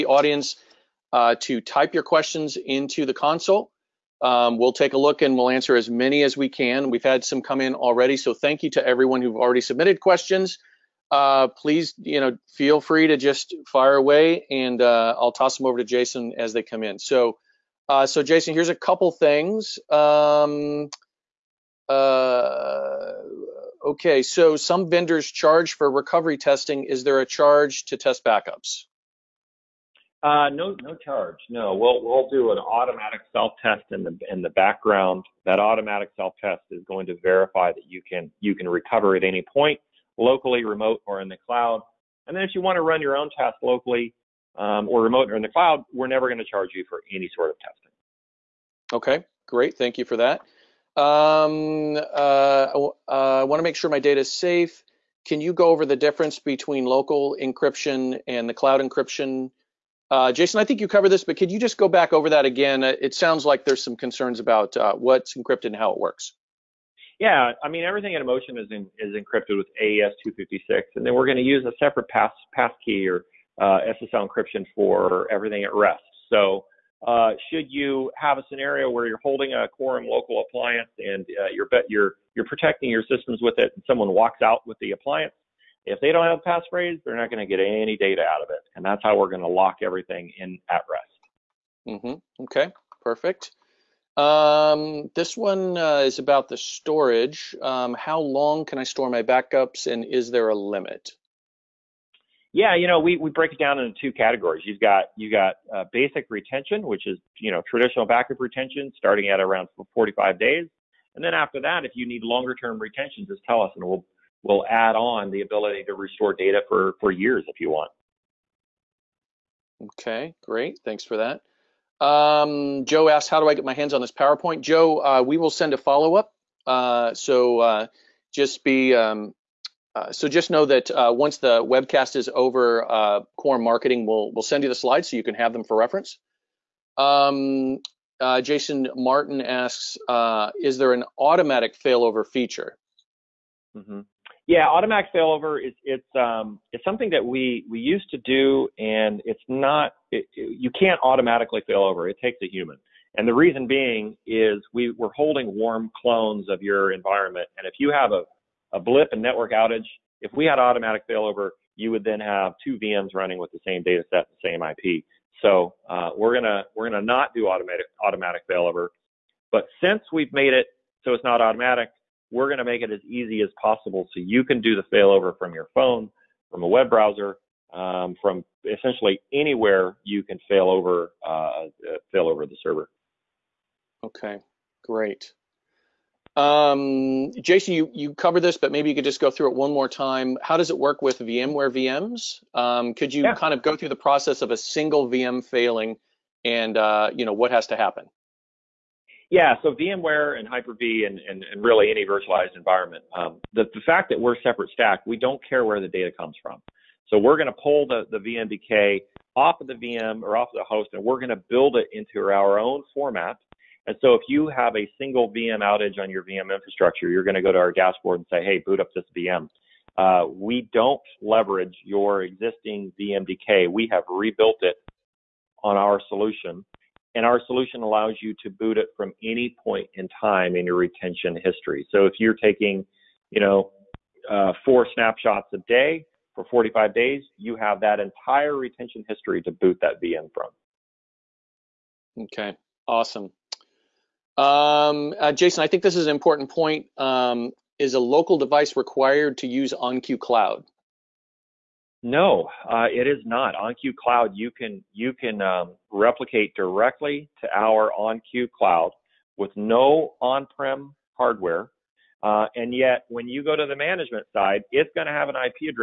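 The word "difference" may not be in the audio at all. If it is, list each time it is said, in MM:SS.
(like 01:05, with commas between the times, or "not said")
00:55.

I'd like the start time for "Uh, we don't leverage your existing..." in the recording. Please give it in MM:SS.
03:39.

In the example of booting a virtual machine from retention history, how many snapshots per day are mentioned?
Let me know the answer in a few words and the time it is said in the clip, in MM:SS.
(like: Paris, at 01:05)
4, at 03:54.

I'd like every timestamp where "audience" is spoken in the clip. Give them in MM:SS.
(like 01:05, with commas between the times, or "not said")
00:00.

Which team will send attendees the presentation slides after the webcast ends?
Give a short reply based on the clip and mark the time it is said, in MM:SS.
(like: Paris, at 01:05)
Quorum Marketing, at 02:13.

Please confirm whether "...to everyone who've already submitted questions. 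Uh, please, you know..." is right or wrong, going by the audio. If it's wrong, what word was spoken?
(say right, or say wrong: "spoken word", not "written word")
right.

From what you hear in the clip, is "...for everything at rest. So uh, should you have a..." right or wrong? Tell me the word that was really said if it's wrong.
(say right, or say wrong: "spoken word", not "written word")
right.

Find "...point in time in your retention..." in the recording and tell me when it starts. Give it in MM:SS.
03:49.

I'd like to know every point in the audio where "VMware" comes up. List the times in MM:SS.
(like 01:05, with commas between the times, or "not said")
03:11, 03:19.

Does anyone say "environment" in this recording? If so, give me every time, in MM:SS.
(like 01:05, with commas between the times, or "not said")
02:36, 03:22.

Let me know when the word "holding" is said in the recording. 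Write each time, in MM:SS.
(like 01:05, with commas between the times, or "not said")
01:19, 02:35.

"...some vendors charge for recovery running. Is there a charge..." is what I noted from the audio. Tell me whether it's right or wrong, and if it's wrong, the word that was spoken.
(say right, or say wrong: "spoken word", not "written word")
wrong: "testing", not "running".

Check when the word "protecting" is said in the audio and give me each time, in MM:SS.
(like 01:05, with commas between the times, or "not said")
01:22.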